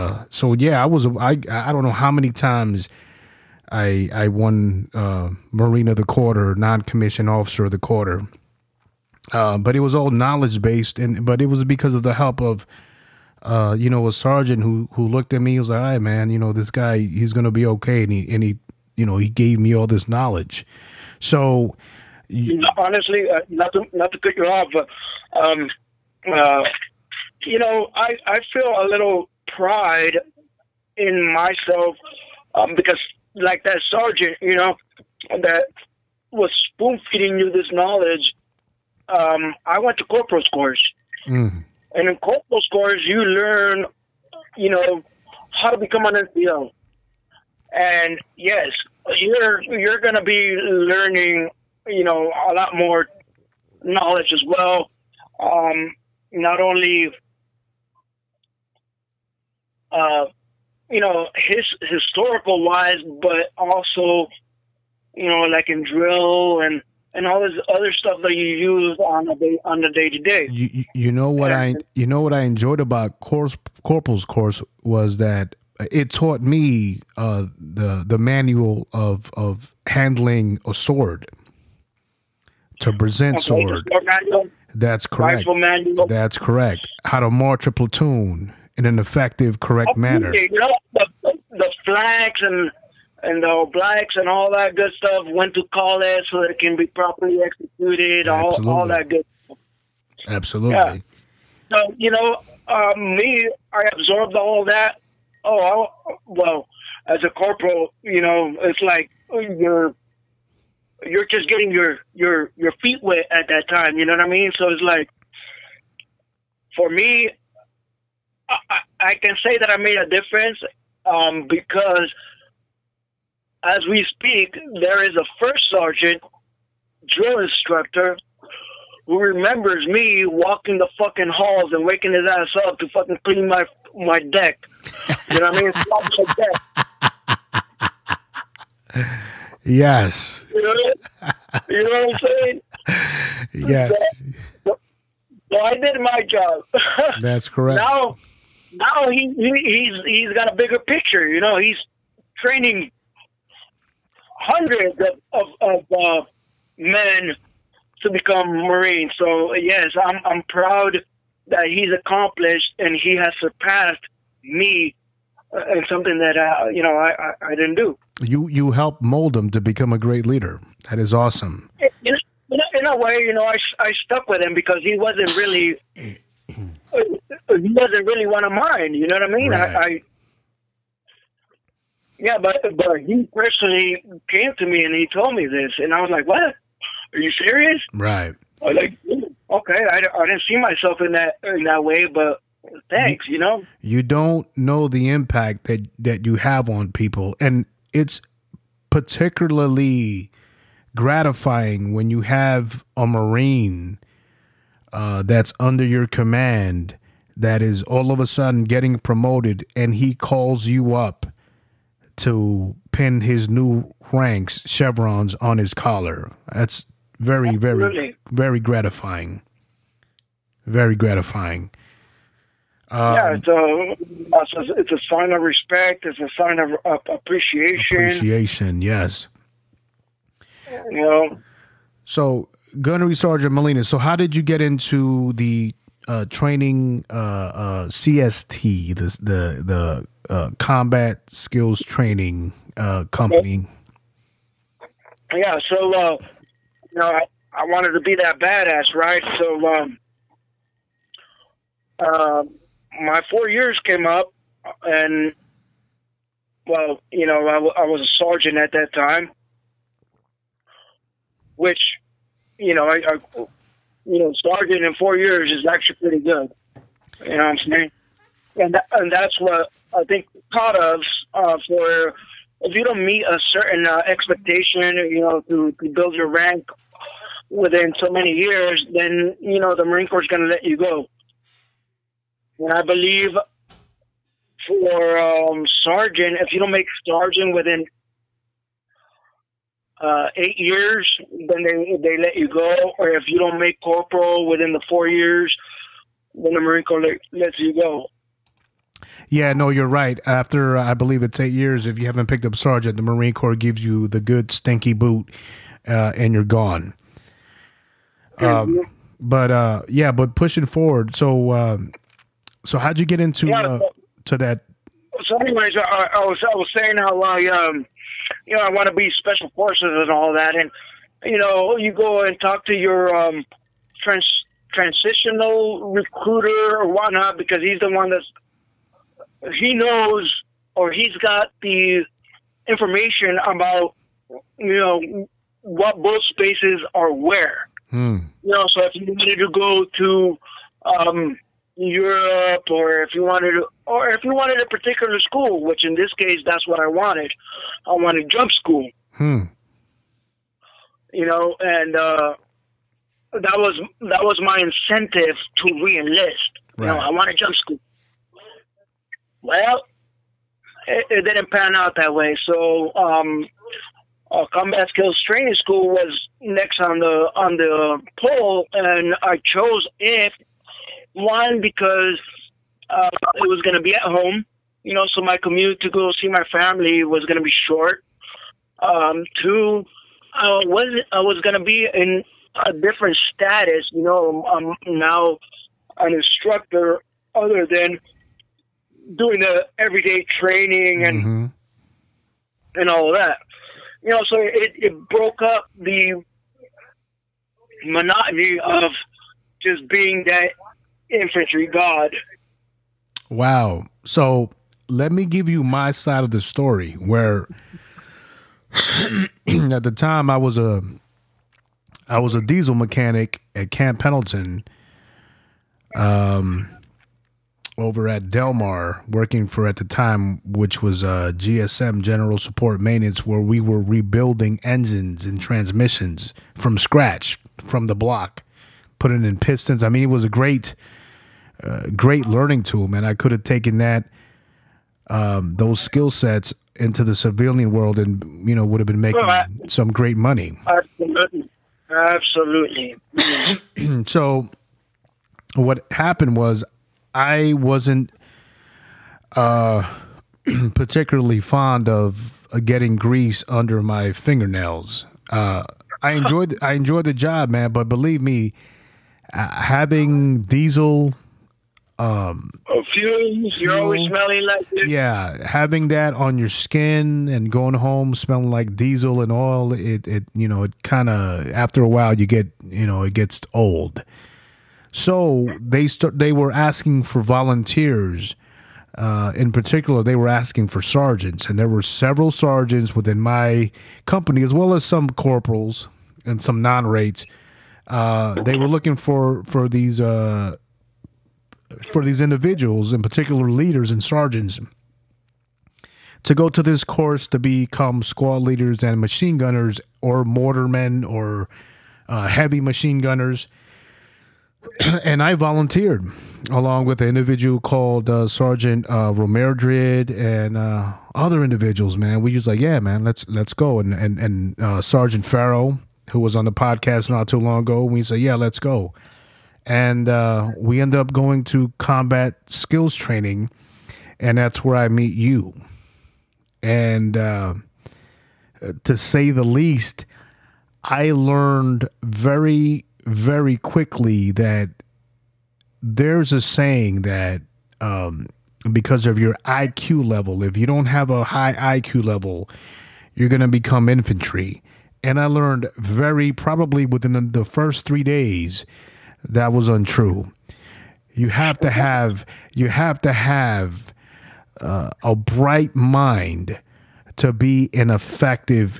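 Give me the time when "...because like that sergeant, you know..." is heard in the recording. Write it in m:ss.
0:32.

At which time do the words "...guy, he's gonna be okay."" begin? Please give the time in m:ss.
0:16.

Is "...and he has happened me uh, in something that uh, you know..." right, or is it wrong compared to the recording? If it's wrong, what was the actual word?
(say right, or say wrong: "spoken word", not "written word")
wrong: "surpassed", not "happened".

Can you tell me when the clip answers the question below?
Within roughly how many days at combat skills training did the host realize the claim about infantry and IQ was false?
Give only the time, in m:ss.
9:07.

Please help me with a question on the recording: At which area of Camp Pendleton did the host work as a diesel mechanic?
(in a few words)
Delmar.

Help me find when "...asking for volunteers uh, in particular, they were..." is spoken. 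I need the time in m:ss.
7:56.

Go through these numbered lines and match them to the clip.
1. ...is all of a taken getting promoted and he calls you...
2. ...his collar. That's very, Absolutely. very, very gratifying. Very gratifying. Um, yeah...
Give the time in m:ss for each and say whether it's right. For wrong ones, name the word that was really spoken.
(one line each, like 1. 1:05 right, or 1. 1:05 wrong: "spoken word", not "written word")
1. 3:27 wrong: "sudden", not "taken"
2. 3:35 right.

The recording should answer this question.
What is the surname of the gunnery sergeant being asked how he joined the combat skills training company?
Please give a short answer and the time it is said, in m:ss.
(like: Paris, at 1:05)
Molina, at 3:53.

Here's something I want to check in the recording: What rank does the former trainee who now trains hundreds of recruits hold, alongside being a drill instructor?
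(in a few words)
First sergeant.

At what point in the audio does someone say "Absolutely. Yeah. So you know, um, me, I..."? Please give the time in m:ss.
1:40.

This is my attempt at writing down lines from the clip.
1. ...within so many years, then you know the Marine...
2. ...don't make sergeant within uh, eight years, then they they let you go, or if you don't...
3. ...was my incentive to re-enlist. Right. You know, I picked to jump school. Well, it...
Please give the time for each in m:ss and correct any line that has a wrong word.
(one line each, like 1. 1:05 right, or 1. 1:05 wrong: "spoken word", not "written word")
1. 4:37 right
2. 4:46 right
3. 5:54 wrong: "wanted", not "picked".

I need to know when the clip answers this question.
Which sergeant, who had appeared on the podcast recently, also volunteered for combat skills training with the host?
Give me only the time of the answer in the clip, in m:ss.
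8:34.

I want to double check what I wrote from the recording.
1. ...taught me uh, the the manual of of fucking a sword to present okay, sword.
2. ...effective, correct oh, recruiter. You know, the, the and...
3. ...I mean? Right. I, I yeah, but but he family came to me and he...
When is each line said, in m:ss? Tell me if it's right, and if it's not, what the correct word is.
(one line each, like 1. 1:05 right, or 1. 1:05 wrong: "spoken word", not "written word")
1. 1:16 wrong: "handling", not "fucking"
2. 1:28 wrong: "manner", not "recruiter"
3. 2:59 wrong: "personally", not "family".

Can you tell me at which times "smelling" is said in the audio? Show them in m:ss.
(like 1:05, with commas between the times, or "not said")
7:44, 7:48.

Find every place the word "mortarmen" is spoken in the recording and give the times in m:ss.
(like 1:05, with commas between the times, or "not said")
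8:20.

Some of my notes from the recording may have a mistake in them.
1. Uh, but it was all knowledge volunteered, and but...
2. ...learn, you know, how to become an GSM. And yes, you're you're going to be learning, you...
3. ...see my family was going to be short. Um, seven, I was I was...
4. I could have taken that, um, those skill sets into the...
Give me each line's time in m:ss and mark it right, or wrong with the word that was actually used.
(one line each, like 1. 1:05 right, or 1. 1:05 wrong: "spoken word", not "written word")
1. 0:09 wrong: "based", not "volunteered"
2. 0:43 wrong: "NCO", not "GSM"
3. 6:16 wrong: "two", not "seven"
4. 7:13 right.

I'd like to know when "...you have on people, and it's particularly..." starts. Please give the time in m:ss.
3:16.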